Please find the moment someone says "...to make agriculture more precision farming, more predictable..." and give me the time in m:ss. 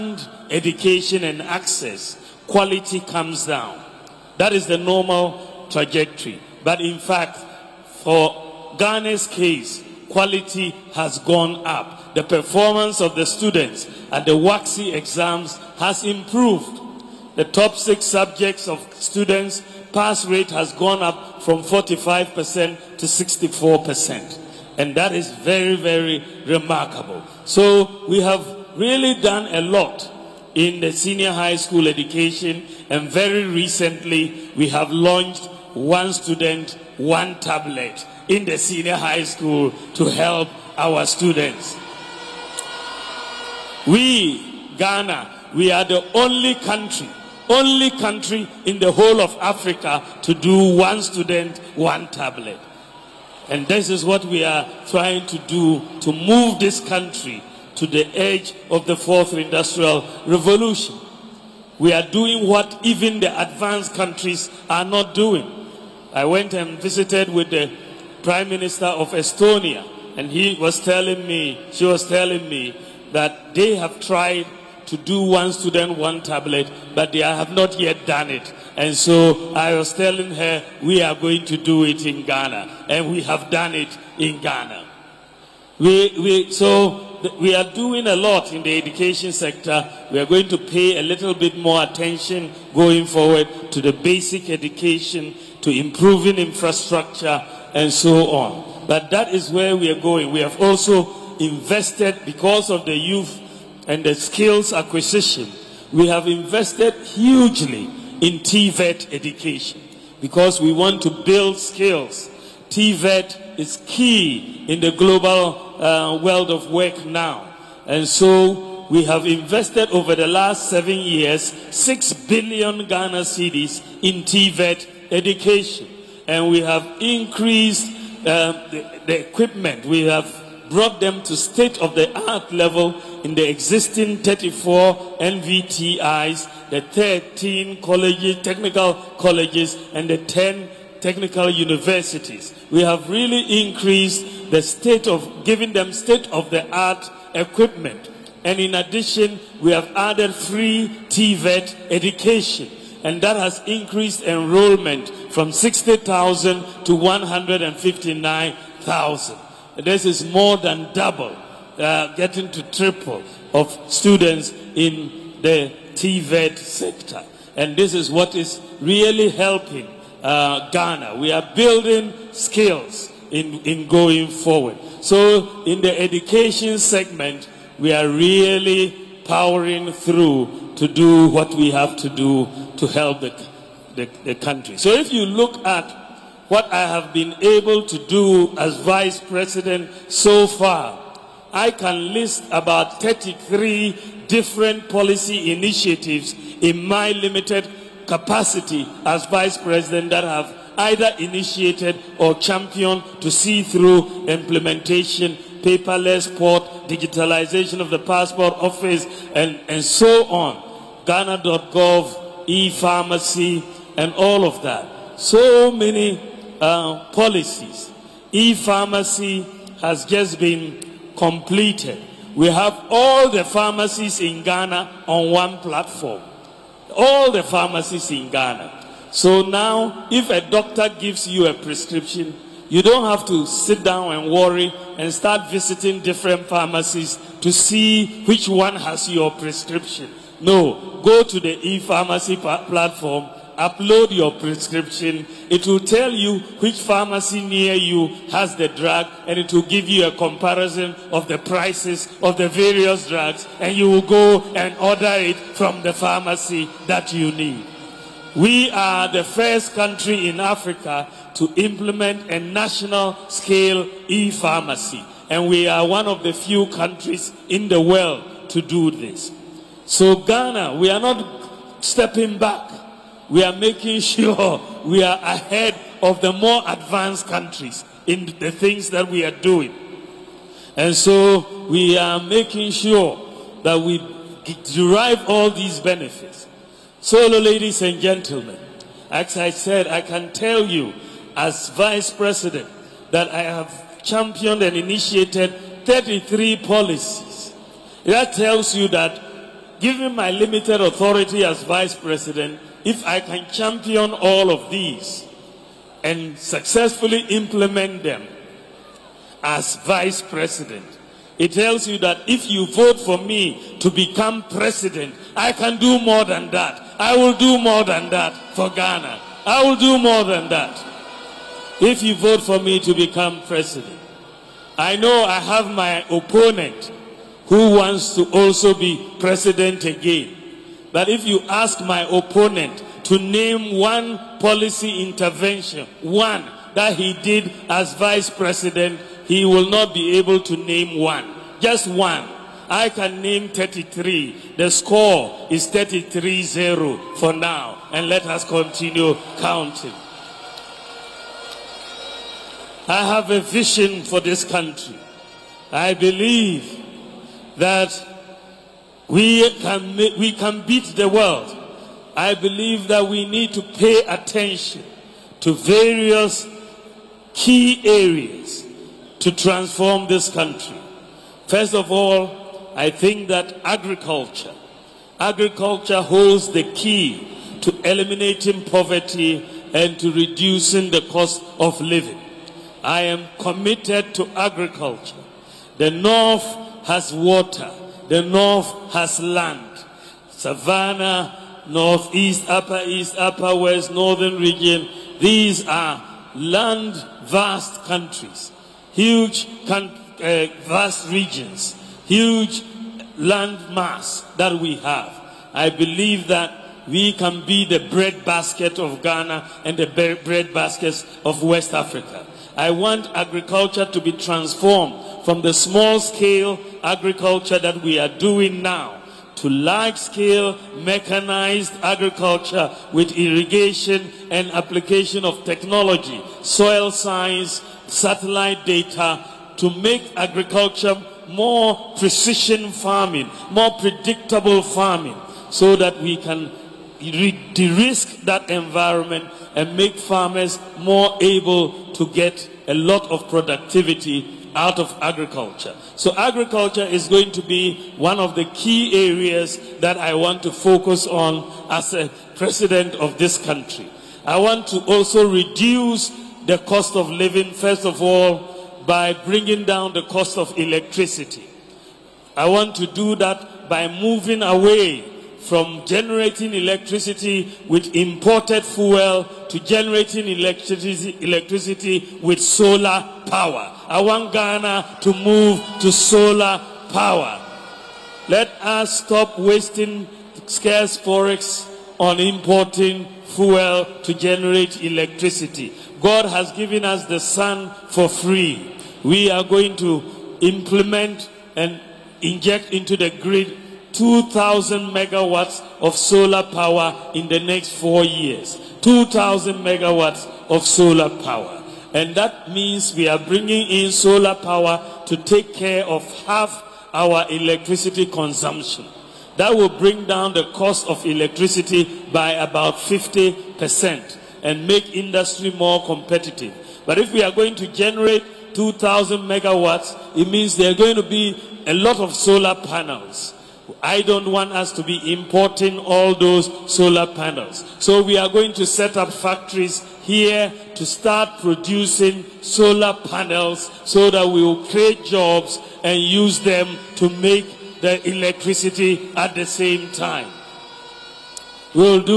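7:09.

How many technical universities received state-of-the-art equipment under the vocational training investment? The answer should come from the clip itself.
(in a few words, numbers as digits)
10.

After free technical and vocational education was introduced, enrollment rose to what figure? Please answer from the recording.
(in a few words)
159,000.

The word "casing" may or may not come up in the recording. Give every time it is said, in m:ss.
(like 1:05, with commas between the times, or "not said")
not said.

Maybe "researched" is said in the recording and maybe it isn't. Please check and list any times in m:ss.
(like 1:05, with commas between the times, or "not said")
not said.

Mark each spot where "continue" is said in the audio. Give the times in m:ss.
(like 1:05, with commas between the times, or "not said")
5:48.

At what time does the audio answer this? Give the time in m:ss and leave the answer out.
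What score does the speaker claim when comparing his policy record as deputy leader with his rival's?
5:45.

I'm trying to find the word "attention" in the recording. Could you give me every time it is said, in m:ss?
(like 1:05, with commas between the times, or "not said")
1:31, 6:04.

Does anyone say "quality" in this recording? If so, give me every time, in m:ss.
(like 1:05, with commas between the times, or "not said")
0:02, 0:10.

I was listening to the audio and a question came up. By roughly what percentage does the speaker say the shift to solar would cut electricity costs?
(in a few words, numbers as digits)
50%.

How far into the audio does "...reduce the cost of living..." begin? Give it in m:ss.
7:35.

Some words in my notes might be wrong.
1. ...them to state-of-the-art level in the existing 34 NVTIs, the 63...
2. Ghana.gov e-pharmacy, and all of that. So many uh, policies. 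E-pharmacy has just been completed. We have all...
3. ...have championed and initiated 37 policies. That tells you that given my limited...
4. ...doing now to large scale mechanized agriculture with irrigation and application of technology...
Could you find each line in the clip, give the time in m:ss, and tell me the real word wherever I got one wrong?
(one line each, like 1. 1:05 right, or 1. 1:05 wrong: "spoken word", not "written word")
1. 2:10 wrong: "13", not "63"
2. 3:31 right
3. 4:53 wrong: "33", not "37"
4. 6:58 right.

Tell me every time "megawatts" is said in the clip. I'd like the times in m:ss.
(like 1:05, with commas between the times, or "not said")
8:14, 8:19, 8:39.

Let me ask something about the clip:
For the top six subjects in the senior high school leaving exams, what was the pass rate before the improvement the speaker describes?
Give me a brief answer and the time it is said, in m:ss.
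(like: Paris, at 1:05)
45%, at 0:21.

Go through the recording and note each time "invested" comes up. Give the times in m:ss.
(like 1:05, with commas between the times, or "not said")
1:41, 1:46, 1:59.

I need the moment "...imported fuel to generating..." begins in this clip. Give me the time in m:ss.
7:47.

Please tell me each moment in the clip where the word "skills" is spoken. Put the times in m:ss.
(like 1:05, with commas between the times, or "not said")
1:44, 1:51, 2:52.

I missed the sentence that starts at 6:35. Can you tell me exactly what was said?
These are land vast countries, huge con uh, vast regions, huge land mass that we have.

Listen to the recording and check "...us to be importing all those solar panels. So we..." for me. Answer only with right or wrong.
right.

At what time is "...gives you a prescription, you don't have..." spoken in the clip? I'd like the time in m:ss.
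3:50.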